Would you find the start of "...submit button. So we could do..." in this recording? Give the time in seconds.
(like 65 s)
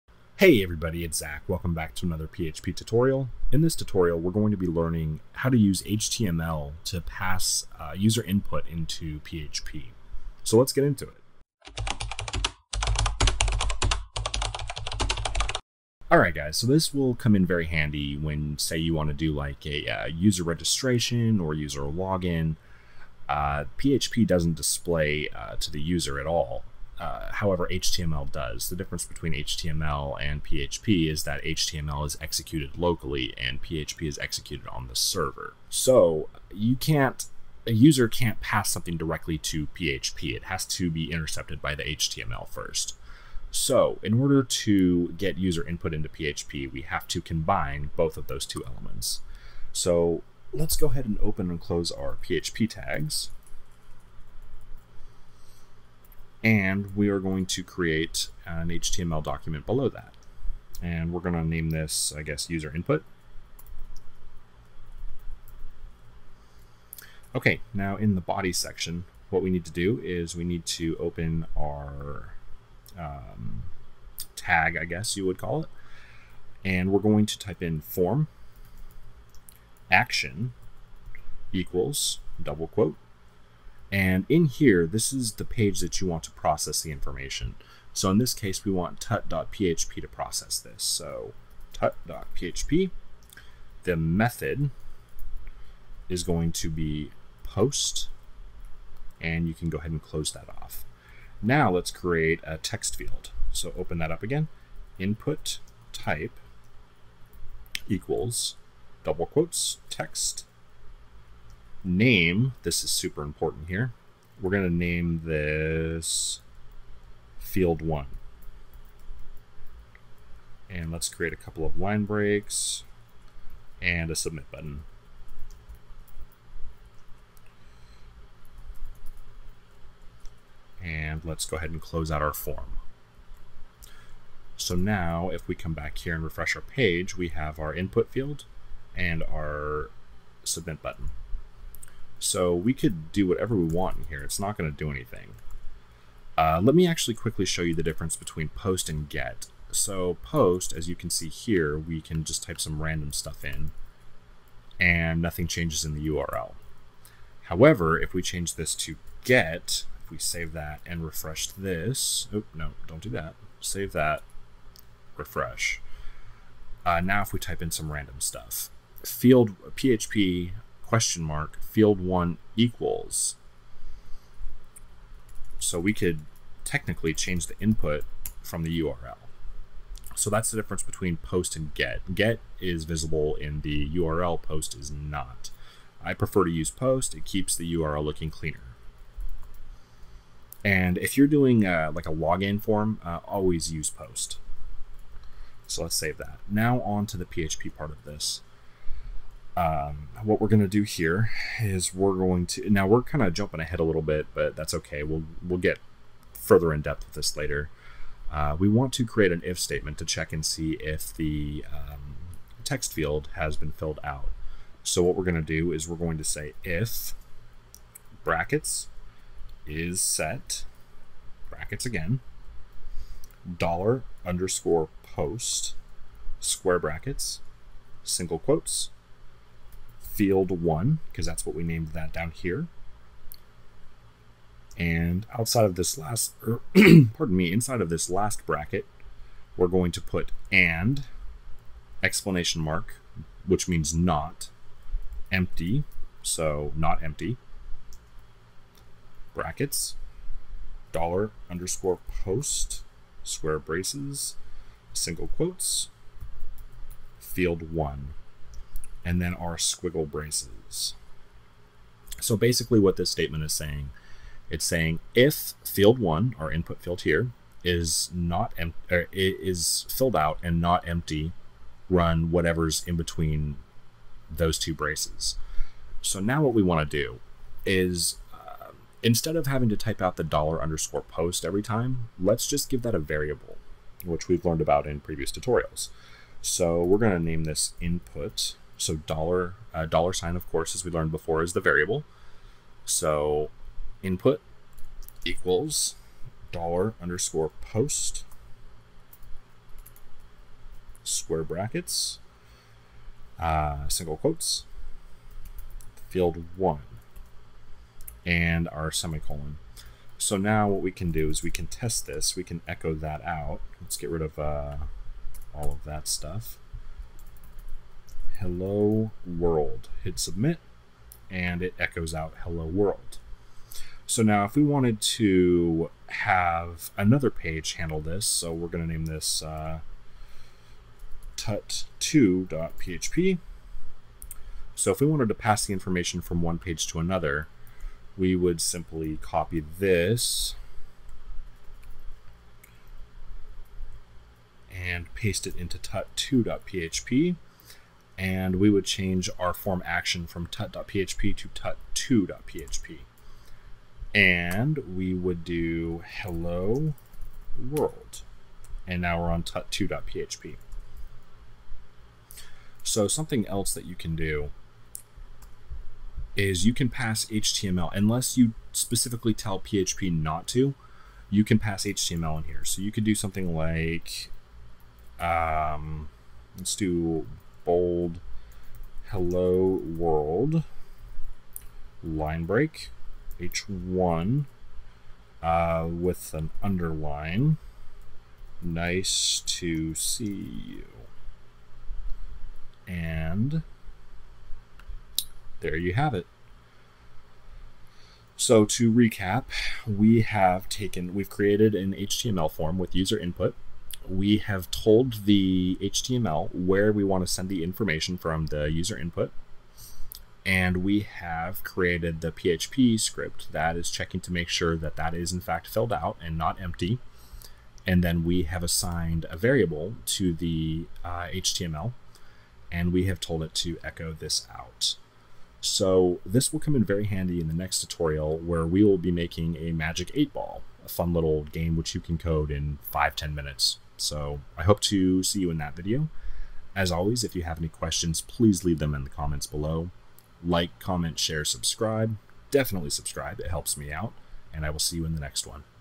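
140 s.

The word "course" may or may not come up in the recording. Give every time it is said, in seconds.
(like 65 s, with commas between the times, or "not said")
290 s.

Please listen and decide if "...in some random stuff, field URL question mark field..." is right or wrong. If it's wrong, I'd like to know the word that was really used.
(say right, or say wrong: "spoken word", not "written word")
wrong: "PHP", not "URL".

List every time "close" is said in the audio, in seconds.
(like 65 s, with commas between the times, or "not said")
51 s, 100 s, 131 s.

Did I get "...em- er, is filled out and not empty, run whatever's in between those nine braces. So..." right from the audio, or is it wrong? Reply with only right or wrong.
wrong.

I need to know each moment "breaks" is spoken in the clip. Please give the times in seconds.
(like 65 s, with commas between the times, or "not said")
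122 s, 382 s.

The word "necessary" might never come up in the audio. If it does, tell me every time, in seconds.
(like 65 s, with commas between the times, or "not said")
not said.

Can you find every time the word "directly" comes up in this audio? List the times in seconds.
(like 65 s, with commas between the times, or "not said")
38 s.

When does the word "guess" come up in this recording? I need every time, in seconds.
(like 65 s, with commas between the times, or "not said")
62 s, 74 s.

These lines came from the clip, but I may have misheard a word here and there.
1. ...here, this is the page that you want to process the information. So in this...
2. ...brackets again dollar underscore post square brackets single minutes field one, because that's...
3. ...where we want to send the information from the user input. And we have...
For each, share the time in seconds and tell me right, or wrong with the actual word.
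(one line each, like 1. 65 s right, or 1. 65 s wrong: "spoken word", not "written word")
1. 84 s right
2. 221 s wrong: "quotes", not "minutes"
3. 406 s right.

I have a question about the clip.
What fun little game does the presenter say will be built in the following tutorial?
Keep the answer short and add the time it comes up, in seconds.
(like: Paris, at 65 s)
magic eight ball, at 429 s.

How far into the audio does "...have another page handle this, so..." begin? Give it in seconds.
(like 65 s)
326 s.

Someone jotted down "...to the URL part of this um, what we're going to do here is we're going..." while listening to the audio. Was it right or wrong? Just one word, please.
wrong.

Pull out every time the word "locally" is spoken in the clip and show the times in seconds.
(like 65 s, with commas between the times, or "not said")
32 s.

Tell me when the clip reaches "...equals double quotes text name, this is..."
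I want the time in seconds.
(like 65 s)
107 s.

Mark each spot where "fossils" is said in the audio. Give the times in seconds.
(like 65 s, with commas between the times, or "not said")
not said.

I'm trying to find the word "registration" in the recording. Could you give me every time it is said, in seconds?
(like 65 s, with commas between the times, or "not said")
20 s.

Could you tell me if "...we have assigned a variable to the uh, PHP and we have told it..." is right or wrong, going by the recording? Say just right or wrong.
wrong.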